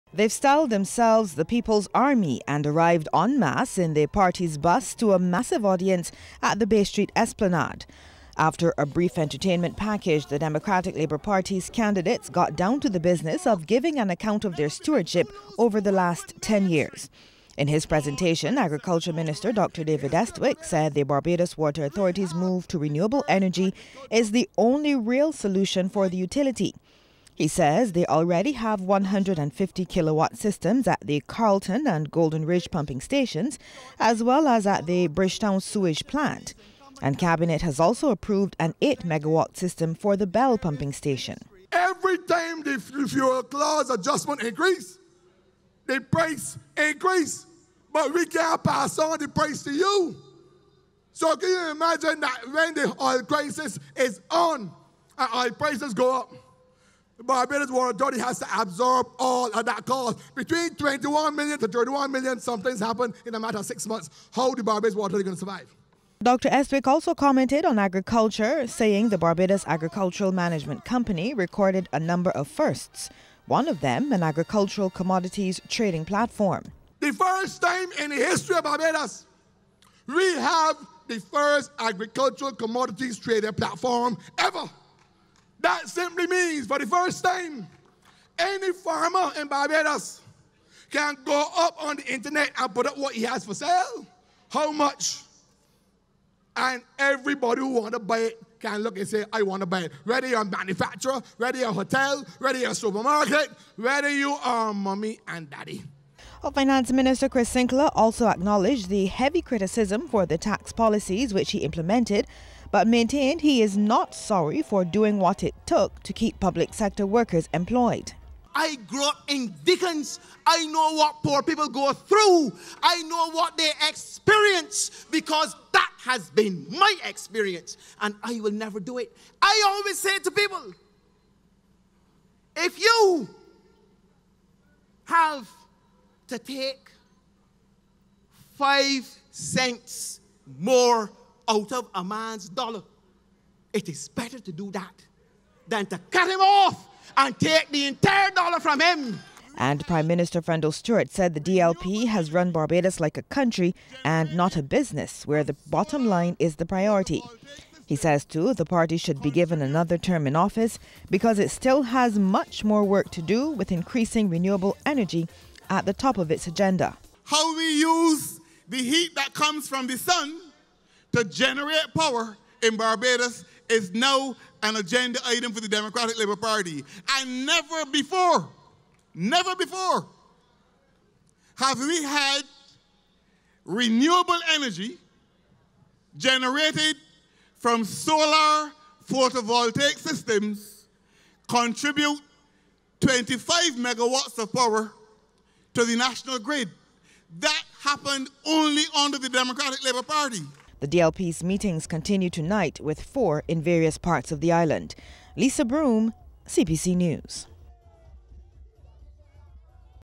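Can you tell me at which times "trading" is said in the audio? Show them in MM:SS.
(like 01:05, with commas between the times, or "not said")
01:15, 01:23.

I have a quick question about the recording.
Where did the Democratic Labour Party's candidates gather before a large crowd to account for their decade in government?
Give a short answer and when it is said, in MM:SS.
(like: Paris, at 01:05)
Bay Street Esplanade, at 00:06.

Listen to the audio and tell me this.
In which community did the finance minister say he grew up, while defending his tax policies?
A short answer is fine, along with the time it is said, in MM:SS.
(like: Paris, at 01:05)
Dickens, at 01:59.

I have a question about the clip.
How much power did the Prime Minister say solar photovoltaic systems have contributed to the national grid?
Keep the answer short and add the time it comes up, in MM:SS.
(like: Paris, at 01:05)
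25 megawatts, at 03:13.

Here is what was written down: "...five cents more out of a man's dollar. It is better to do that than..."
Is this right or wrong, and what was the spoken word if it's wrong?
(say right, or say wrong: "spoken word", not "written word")
right.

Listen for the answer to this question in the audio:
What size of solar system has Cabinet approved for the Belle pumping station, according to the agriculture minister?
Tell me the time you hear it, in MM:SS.
00:38.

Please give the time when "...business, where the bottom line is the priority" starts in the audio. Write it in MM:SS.
02:34.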